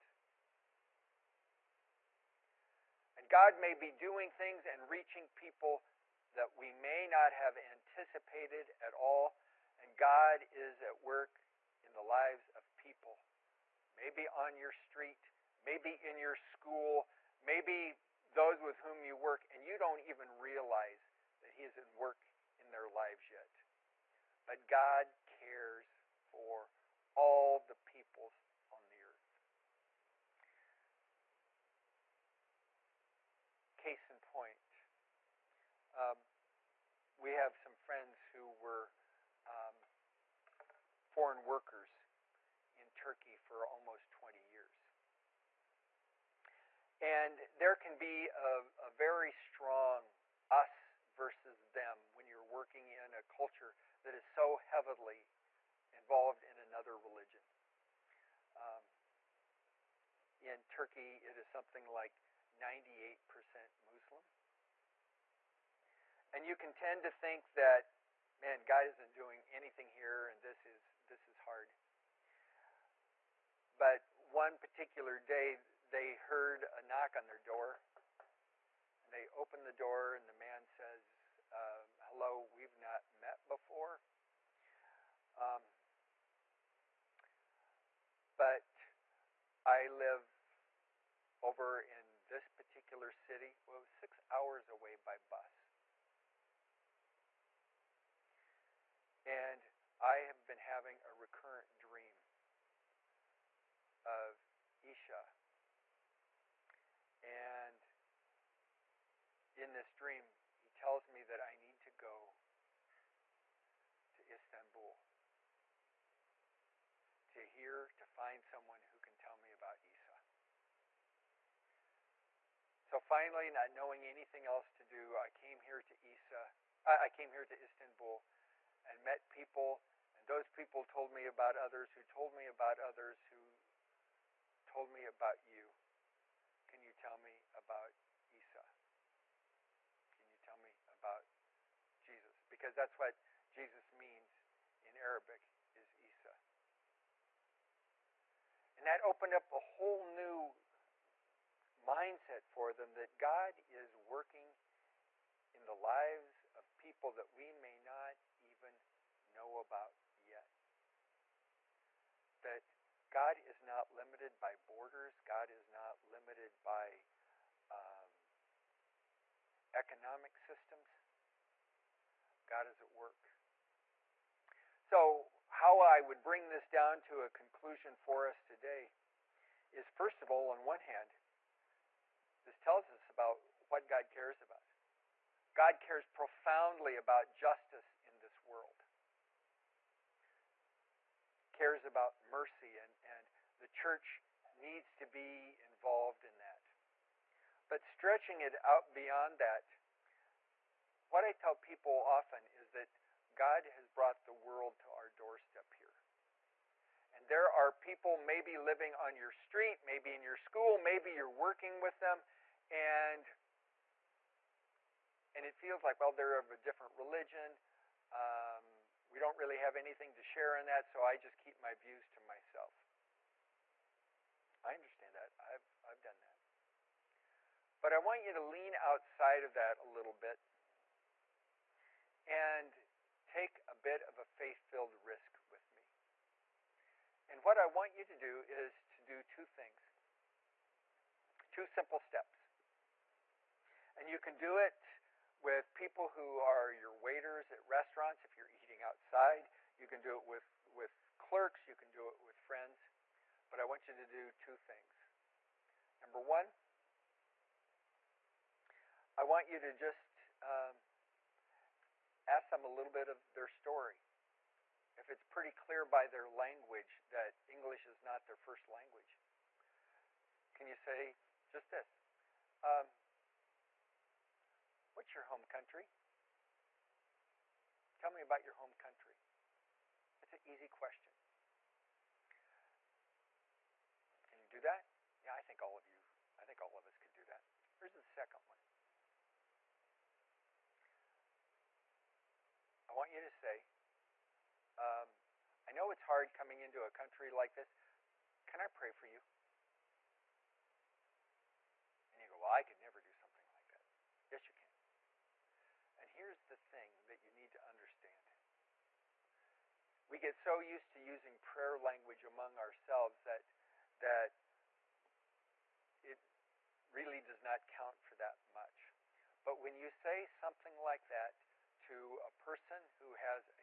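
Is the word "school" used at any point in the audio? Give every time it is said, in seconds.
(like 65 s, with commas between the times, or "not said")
16 s, 210 s.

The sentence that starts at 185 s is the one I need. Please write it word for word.
God cares profoundly about justice in this world, cares about mercy, and, and the church needs to be involved in that.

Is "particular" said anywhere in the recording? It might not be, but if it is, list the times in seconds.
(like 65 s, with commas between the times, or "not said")
74 s, 92 s.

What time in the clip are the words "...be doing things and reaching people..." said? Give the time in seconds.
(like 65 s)
3 s.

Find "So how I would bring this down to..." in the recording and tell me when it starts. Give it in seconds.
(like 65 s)
174 s.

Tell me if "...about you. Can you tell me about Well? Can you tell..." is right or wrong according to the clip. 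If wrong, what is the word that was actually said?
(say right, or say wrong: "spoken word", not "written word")
wrong: "Isa", not "Well".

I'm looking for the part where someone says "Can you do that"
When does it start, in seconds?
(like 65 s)
284 s.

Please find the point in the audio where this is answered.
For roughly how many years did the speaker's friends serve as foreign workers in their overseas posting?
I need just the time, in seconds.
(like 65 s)
43 s.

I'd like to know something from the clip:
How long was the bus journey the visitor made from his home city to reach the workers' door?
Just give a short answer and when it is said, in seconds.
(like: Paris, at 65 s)
6 hours, at 93 s.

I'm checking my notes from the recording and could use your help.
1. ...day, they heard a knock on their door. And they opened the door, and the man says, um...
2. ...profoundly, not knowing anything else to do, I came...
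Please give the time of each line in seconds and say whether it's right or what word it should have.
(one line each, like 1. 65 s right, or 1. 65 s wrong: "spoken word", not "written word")
1. 75 s right
2. 123 s wrong: "finally", not "profoundly".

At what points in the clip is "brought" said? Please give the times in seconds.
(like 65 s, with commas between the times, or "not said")
203 s.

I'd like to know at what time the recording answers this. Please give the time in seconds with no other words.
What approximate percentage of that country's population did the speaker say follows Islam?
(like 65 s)
62 s.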